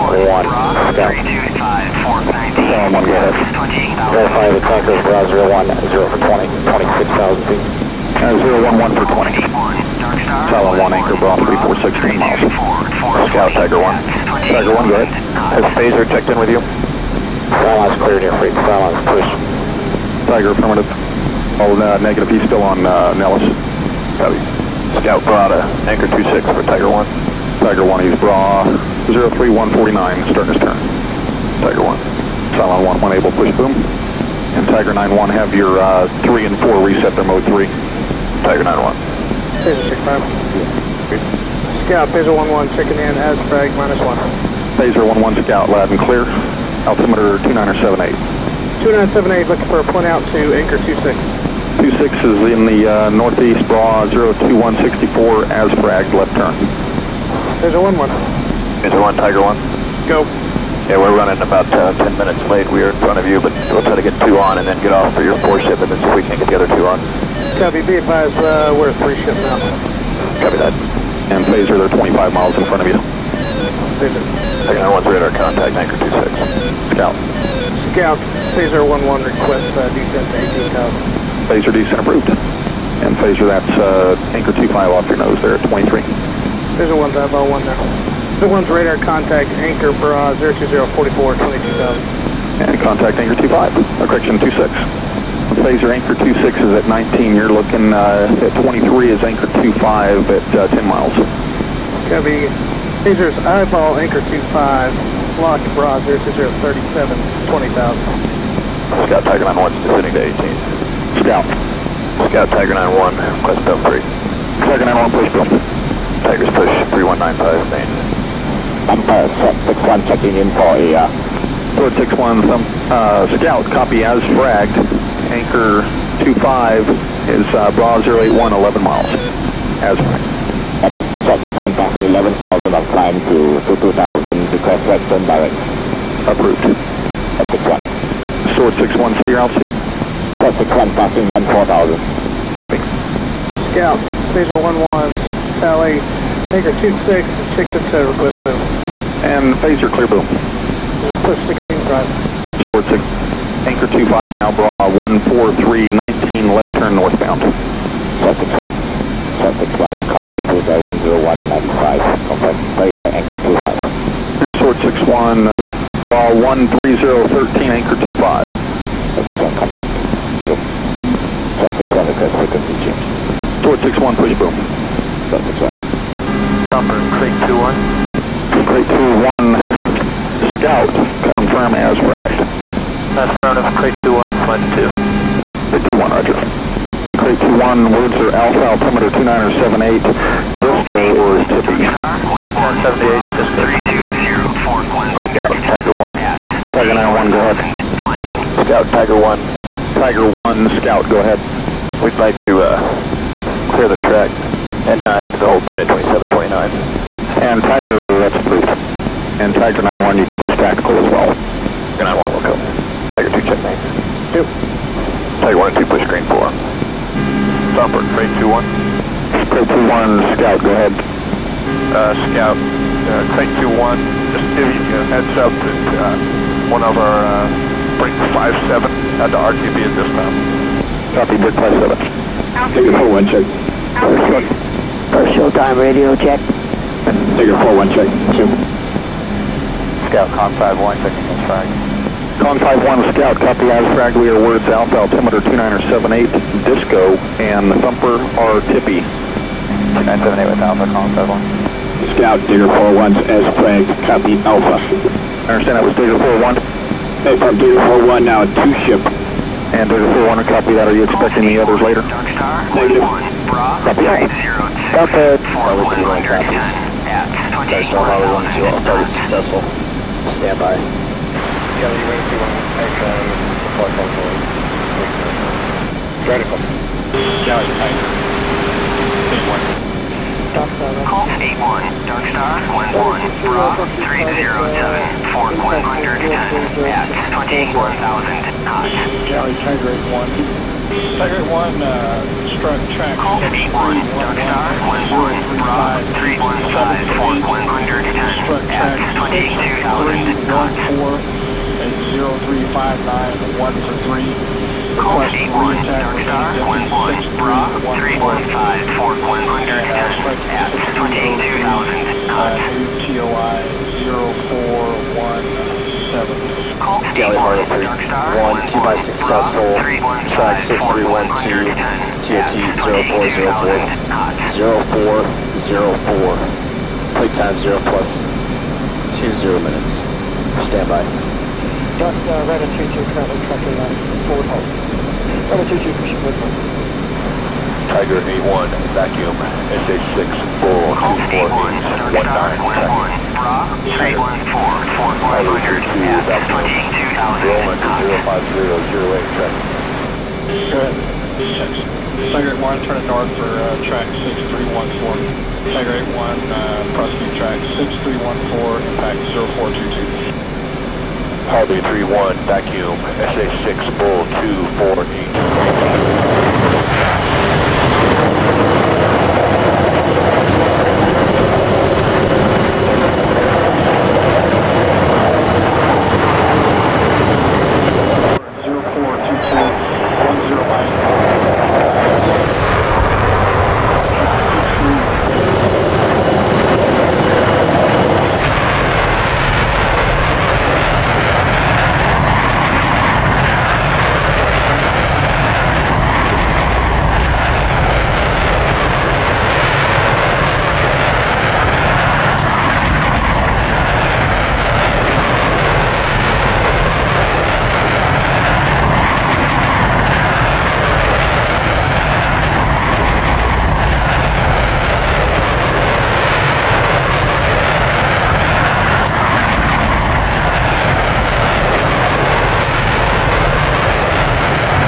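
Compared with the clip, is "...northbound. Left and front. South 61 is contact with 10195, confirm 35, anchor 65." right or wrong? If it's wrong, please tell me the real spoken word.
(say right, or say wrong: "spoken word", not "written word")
wrong: "25", not "65".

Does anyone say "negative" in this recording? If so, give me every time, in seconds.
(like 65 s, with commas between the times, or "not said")
22 s, 262 s.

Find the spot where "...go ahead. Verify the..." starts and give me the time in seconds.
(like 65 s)
3 s.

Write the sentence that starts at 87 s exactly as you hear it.
The one's radar contact anchor for uh, 02044, 22,000.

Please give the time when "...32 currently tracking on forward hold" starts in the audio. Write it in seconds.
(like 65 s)
332 s.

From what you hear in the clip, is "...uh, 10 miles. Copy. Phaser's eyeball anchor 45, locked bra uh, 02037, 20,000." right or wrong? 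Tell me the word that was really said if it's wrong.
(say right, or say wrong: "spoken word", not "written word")
wrong: "25", not "45".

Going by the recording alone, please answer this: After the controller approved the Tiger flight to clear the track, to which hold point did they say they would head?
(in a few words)
2729.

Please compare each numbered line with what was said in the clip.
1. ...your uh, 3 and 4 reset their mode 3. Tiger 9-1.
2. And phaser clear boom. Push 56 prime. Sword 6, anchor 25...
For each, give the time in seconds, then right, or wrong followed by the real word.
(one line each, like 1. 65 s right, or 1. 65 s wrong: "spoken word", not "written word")
1. 35 s right
2. 149 s wrong: "16", not "56".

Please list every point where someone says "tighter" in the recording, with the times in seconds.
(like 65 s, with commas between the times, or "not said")
277 s, 289 s.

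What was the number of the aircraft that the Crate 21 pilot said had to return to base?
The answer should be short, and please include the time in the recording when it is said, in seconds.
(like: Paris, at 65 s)
57, at 228 s.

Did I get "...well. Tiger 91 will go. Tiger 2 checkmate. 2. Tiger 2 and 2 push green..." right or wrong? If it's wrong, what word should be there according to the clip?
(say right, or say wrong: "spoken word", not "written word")
wrong: "1", not "2".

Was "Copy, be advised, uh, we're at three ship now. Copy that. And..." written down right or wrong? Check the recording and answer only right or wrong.
right.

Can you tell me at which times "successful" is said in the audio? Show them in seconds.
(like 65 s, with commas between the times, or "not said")
269 s, 319 s.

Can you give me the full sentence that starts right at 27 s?
Tiger 1, he's bra 03149, stern is turn.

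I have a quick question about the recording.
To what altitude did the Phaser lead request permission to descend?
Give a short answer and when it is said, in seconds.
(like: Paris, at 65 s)
18,000, at 81 s.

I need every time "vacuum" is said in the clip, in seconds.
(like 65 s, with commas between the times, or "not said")
338 s, 346 s, 362 s.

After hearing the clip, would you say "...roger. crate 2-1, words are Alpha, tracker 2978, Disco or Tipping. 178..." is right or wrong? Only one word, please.
wrong.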